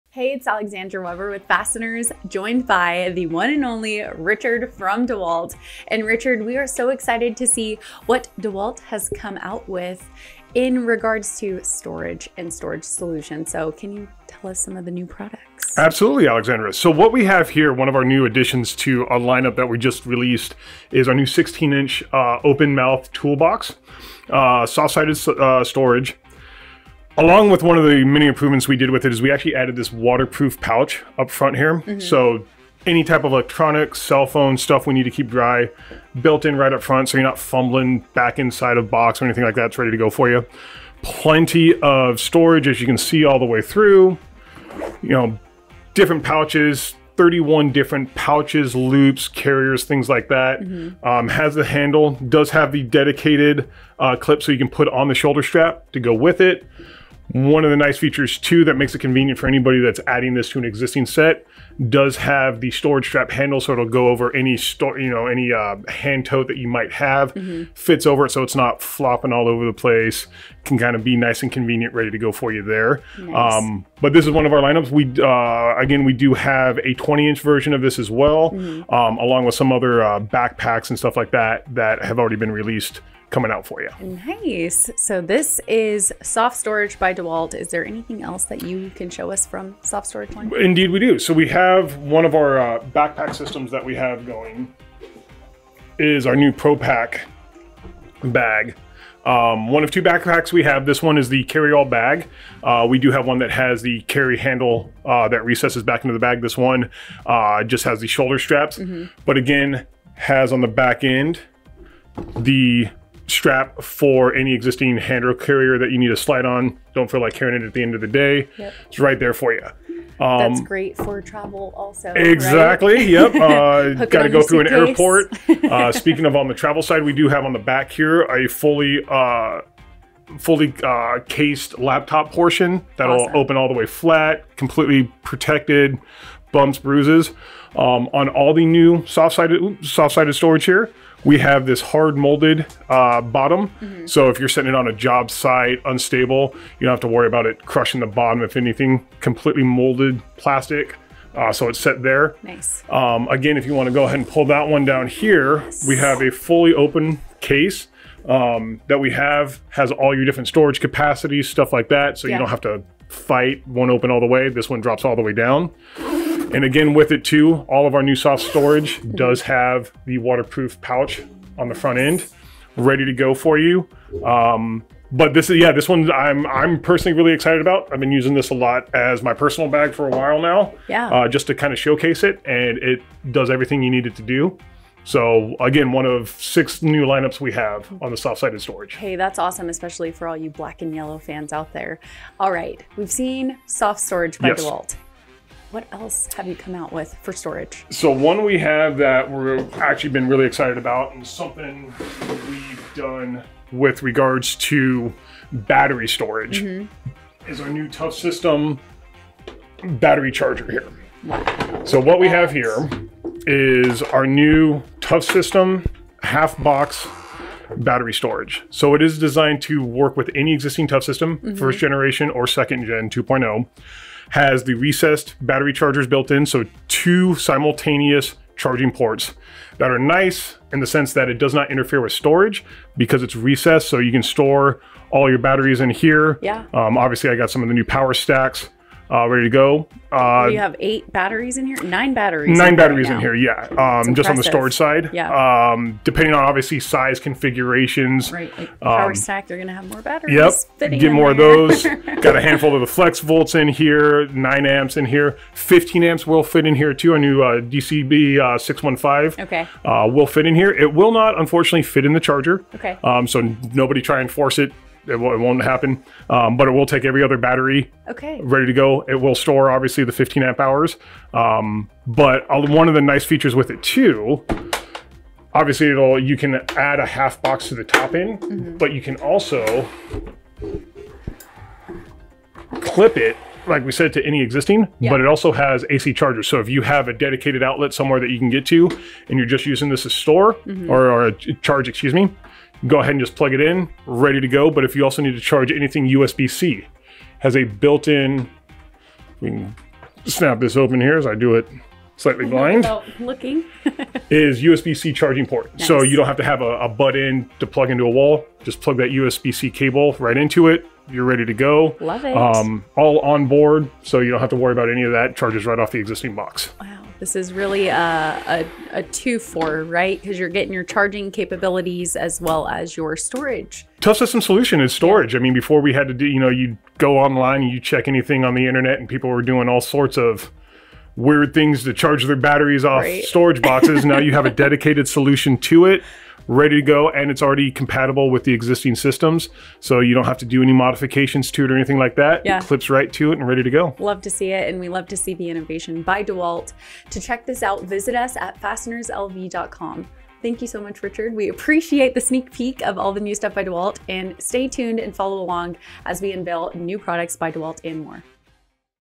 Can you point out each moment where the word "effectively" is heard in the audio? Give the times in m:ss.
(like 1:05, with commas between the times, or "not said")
not said.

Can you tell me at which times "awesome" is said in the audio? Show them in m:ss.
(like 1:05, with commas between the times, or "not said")
2:13, 3:09.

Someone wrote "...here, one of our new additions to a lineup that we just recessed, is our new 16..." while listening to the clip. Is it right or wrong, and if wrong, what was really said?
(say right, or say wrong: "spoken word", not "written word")
wrong: "released", not "recessed".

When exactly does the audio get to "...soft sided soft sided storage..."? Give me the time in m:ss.
2:19.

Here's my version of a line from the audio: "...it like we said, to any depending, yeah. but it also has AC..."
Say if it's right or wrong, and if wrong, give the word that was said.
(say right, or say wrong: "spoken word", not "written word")
wrong: "existing", not "depending".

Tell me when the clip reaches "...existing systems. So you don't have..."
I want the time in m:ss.
5:38.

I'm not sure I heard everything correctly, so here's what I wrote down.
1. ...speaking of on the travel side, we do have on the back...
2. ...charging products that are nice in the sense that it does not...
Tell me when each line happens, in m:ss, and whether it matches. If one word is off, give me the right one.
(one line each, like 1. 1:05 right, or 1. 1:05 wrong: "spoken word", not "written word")
1. 2:05 right
2. 3:48 wrong: "ports", not "products".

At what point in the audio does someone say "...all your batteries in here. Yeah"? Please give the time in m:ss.
3:55.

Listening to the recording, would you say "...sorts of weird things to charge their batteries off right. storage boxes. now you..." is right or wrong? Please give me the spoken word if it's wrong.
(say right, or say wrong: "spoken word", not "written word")
right.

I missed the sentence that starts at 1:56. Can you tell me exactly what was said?
Don't feel like carrying it at the end of the day.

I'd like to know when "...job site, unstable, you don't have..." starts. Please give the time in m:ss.
2:24.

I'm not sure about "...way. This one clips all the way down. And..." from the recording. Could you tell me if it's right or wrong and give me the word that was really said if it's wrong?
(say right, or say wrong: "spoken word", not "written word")
wrong: "drops", not "clips".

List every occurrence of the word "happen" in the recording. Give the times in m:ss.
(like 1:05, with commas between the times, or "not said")
4:25.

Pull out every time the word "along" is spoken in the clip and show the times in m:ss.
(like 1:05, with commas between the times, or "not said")
0:27, 1:19, 5:55.